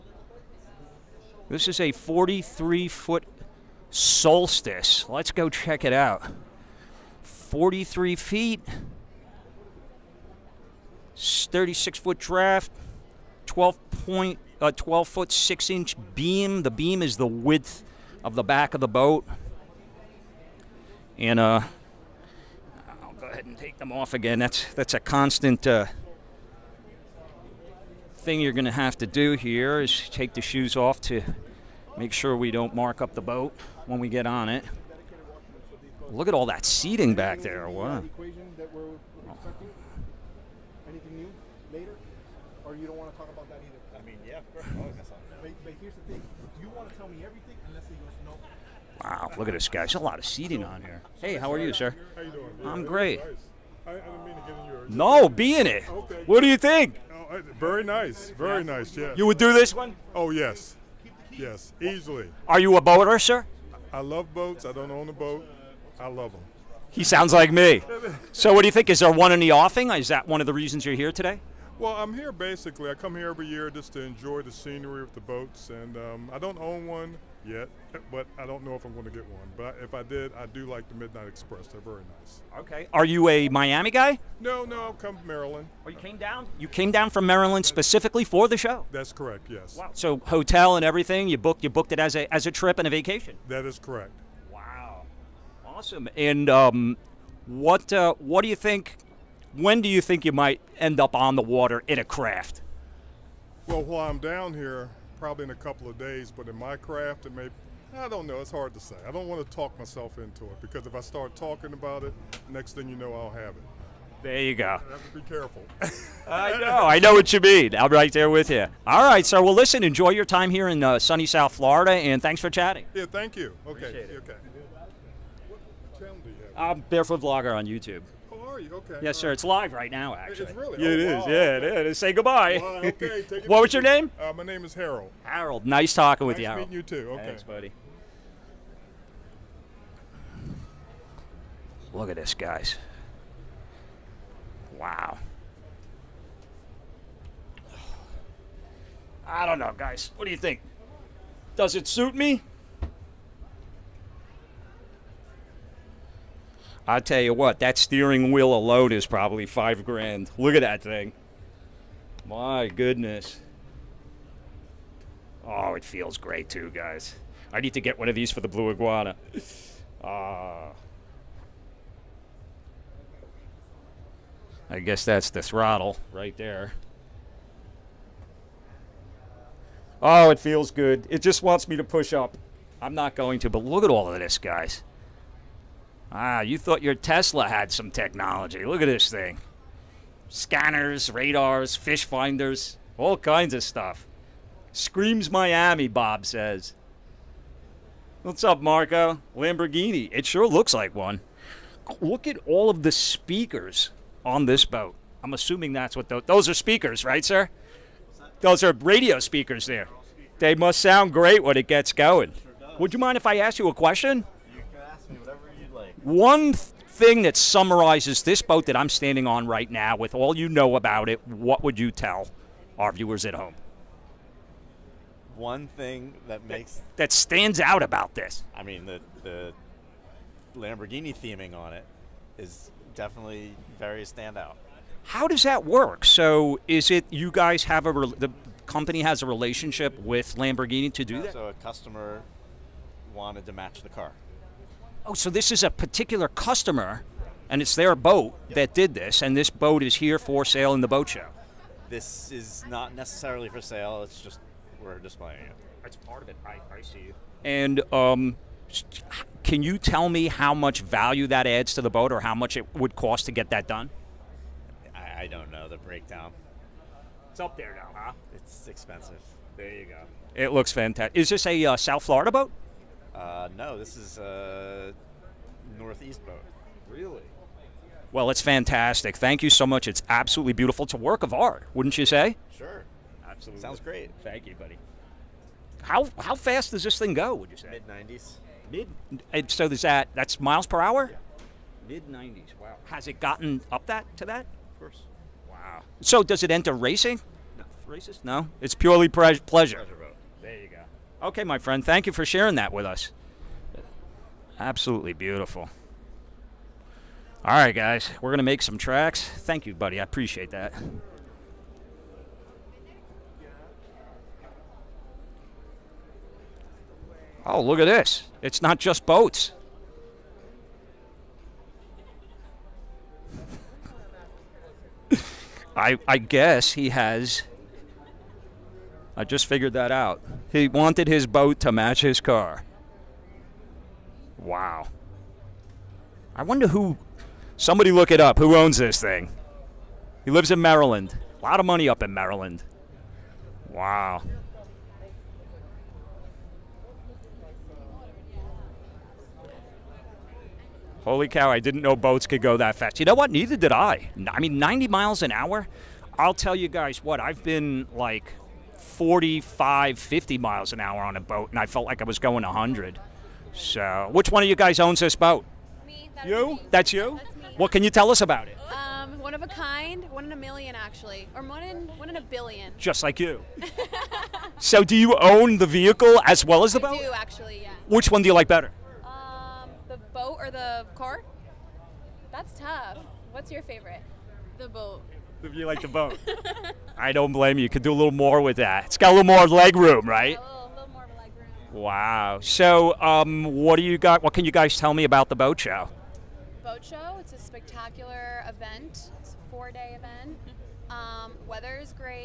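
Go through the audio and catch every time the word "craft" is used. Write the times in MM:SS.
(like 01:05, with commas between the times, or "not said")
01:42, 01:46.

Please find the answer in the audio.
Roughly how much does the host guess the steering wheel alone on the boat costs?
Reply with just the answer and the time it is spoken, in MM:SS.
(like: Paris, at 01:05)
5 grand, at 02:39.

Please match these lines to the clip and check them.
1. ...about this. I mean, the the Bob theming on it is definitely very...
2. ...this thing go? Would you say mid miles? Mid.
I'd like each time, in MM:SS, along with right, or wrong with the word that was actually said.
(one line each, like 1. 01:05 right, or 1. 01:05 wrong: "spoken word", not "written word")
1. 03:47 wrong: "Lamborghini", not "Bob"
2. 04:46 wrong: "nineties", not "miles".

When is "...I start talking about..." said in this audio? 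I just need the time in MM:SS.
01:50.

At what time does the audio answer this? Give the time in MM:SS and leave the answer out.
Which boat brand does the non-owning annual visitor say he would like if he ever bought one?
01:20.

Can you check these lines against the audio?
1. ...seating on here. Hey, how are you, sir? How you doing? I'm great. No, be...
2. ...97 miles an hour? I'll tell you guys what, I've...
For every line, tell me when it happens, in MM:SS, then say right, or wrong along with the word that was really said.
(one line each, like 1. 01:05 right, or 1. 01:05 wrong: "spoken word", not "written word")
1. 00:50 right
2. 05:54 wrong: "90", not "97".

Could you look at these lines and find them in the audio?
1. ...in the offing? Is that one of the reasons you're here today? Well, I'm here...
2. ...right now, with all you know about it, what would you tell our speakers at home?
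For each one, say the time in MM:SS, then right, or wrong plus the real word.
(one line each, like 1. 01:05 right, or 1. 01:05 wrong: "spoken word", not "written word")
1. 01:09 right
2. 03:39 wrong: "viewers", not "speakers".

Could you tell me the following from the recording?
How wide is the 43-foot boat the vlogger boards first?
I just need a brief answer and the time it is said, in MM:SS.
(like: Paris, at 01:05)
12 foot 6 inch, at 00:14.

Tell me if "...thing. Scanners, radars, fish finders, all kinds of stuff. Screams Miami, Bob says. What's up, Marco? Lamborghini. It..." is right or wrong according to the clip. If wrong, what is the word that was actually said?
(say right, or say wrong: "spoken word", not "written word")
right.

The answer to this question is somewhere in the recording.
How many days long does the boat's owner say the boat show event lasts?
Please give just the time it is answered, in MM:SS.
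06:39.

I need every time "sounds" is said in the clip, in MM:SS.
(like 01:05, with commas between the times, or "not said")
01:07, 03:30, 04:43.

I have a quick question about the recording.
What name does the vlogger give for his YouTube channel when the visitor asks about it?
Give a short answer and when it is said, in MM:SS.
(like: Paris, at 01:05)
Barefoot Vlogger, at 02:06.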